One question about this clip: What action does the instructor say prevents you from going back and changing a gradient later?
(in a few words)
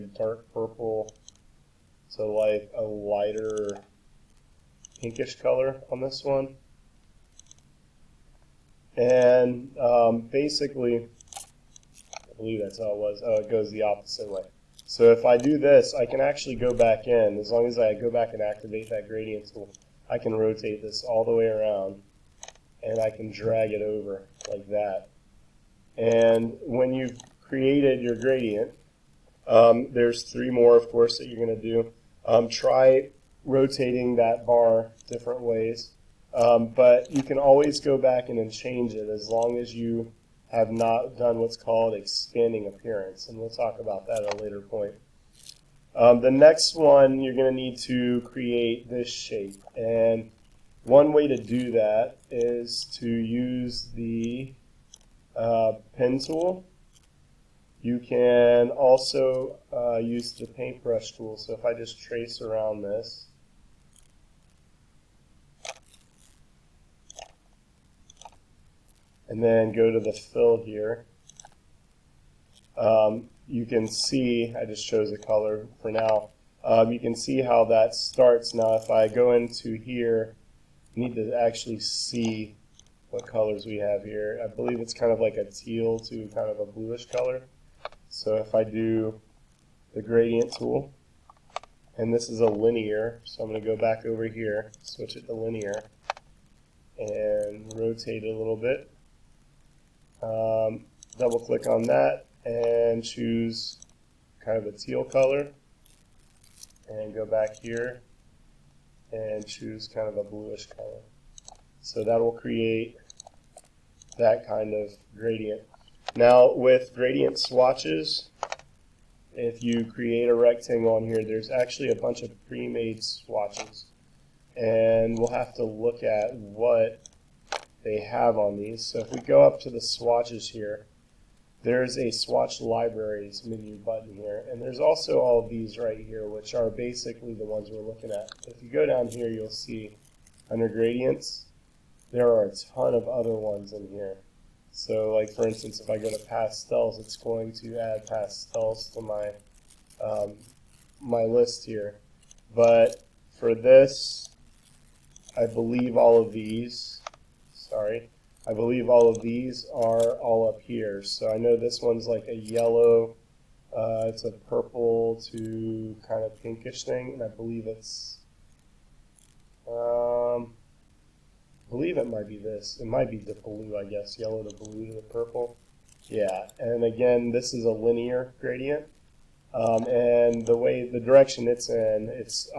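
Expanding appearance.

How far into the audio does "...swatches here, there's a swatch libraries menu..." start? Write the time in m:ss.
2:09.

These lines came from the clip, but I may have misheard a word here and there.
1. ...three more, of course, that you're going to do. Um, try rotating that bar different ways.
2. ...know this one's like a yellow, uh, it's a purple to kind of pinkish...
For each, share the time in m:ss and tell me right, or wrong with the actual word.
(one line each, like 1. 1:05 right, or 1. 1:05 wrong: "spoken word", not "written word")
1. 0:30 right
2. 2:41 right.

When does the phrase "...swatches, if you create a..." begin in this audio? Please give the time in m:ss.
1:57.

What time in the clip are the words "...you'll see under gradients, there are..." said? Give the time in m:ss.
2:19.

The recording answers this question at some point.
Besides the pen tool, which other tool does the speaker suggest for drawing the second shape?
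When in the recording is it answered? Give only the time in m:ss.
1:00.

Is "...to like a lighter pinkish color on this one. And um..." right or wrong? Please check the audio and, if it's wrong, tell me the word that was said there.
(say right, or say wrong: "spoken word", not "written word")
right.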